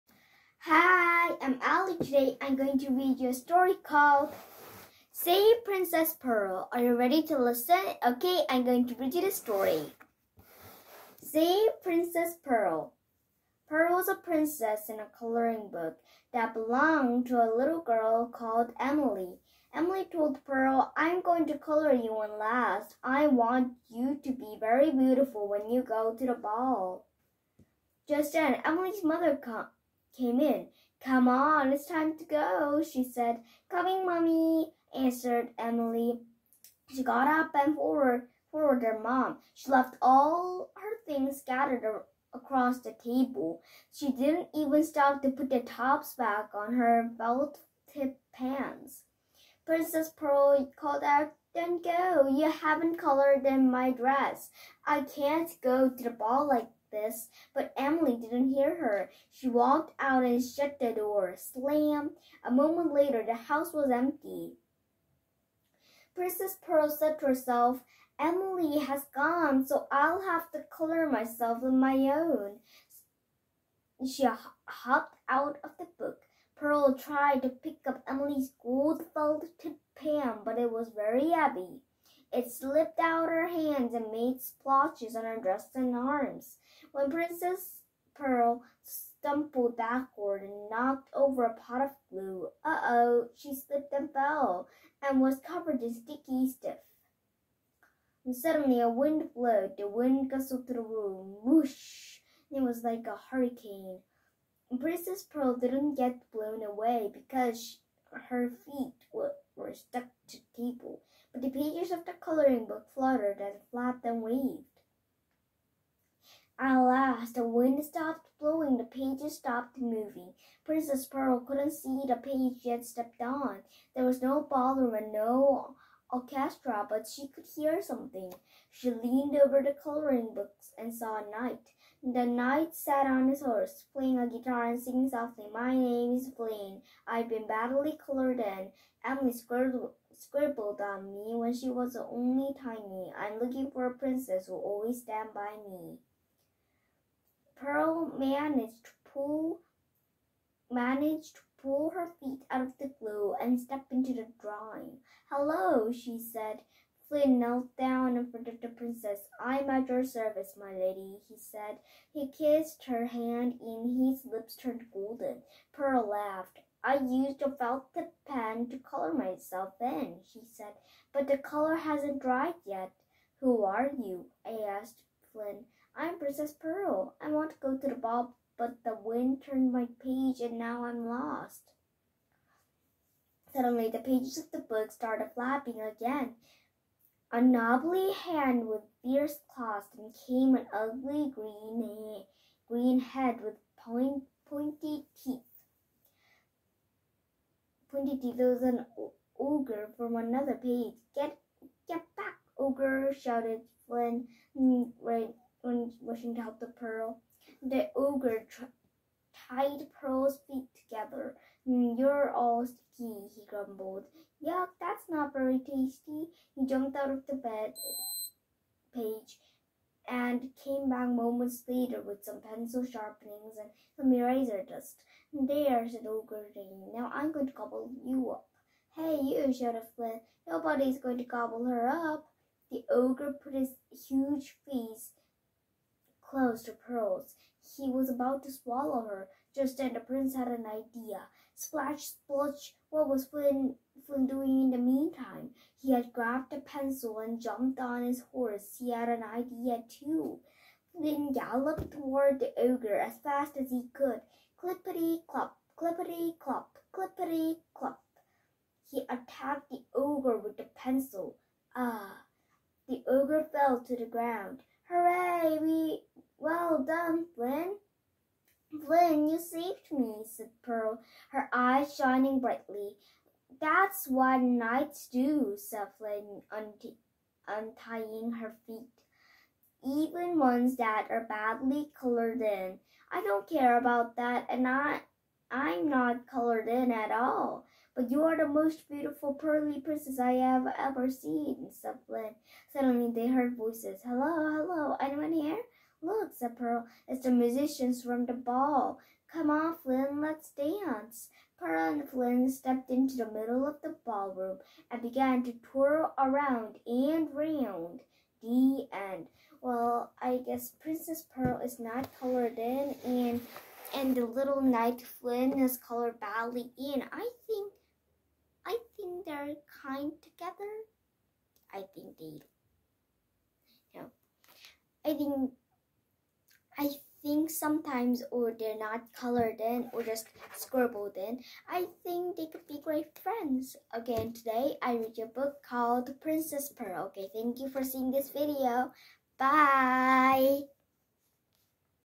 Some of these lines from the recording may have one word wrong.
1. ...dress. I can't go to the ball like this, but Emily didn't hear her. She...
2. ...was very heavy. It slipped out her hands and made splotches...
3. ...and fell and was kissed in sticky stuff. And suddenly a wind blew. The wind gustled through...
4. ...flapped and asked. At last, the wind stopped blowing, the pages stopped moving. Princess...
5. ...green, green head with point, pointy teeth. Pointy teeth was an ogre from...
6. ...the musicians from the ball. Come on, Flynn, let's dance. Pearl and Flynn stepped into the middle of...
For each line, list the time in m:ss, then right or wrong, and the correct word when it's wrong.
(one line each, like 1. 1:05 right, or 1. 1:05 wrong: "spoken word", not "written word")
1. 0:53 right
2. 1:20 right
3. 1:33 wrong: "covered", not "kissed"
4. 1:53 wrong: "waved", not "asked"
5. 3:11 right
6. 4:57 right.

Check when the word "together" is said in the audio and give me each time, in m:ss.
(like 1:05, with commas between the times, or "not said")
3:30, 5:20.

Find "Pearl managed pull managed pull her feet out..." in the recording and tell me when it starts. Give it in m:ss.
2:27.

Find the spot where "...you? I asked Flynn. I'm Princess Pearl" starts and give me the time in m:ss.
2:53.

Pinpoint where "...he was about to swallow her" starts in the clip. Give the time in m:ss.
3:57.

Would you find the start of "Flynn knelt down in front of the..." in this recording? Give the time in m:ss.
2:37.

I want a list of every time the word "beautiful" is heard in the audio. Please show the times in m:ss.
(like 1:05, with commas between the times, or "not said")
0:24, 4:48.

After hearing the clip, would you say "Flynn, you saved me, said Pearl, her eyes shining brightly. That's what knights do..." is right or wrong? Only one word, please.
right.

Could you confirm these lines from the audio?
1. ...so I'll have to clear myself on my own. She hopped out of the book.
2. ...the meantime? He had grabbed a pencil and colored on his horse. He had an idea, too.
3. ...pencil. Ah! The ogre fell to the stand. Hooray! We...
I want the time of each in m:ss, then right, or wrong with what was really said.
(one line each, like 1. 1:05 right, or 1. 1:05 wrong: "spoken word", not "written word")
1. 1:09 right
2. 4:04 wrong: "jumped", not "colored"
3. 4:20 wrong: "ground", not "stand".